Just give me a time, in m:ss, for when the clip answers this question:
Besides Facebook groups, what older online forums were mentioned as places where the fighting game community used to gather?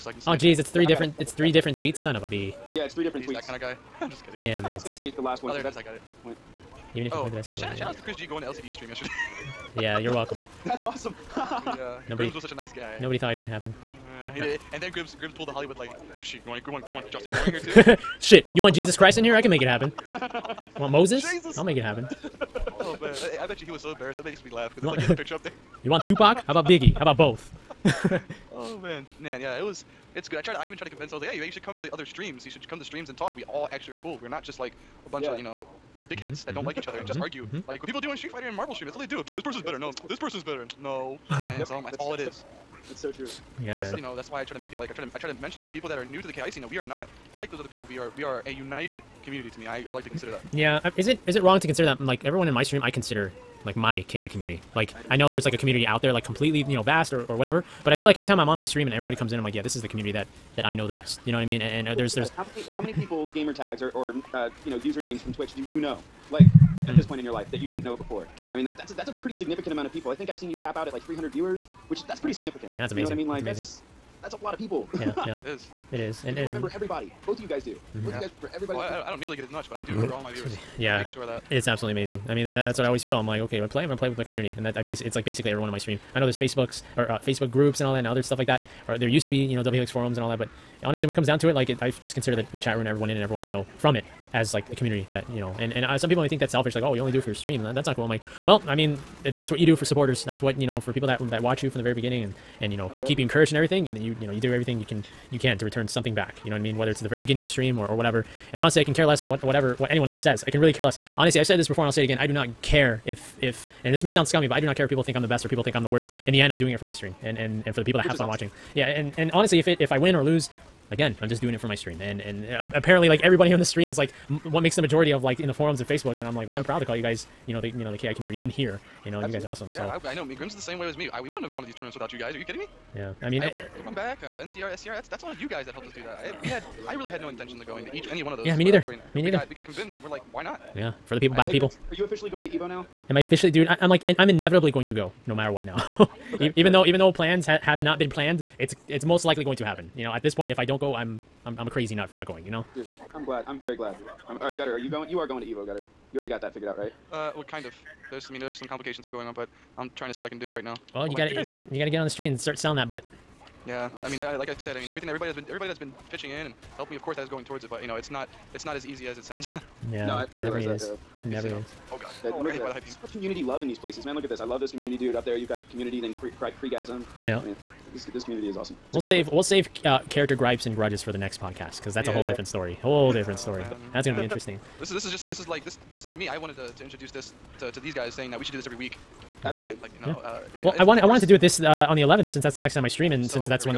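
1:29.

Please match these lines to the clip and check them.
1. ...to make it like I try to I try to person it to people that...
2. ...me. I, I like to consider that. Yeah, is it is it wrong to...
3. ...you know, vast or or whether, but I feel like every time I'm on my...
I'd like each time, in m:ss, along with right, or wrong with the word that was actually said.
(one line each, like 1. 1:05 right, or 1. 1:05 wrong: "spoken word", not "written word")
1. 0:44 wrong: "mention", not "person"
2. 0:49 right
3. 0:56 wrong: "whatever", not "whether".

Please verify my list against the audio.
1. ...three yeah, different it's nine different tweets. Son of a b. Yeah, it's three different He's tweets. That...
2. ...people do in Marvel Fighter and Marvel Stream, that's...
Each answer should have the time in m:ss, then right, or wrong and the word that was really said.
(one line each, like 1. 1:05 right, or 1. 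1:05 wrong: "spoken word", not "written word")
1. 0:00 wrong: "three", not "nine"
2. 0:37 wrong: "Street", not "Marvel".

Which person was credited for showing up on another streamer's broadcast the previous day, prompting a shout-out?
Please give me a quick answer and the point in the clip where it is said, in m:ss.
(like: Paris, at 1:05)
Chris G, at 0:08.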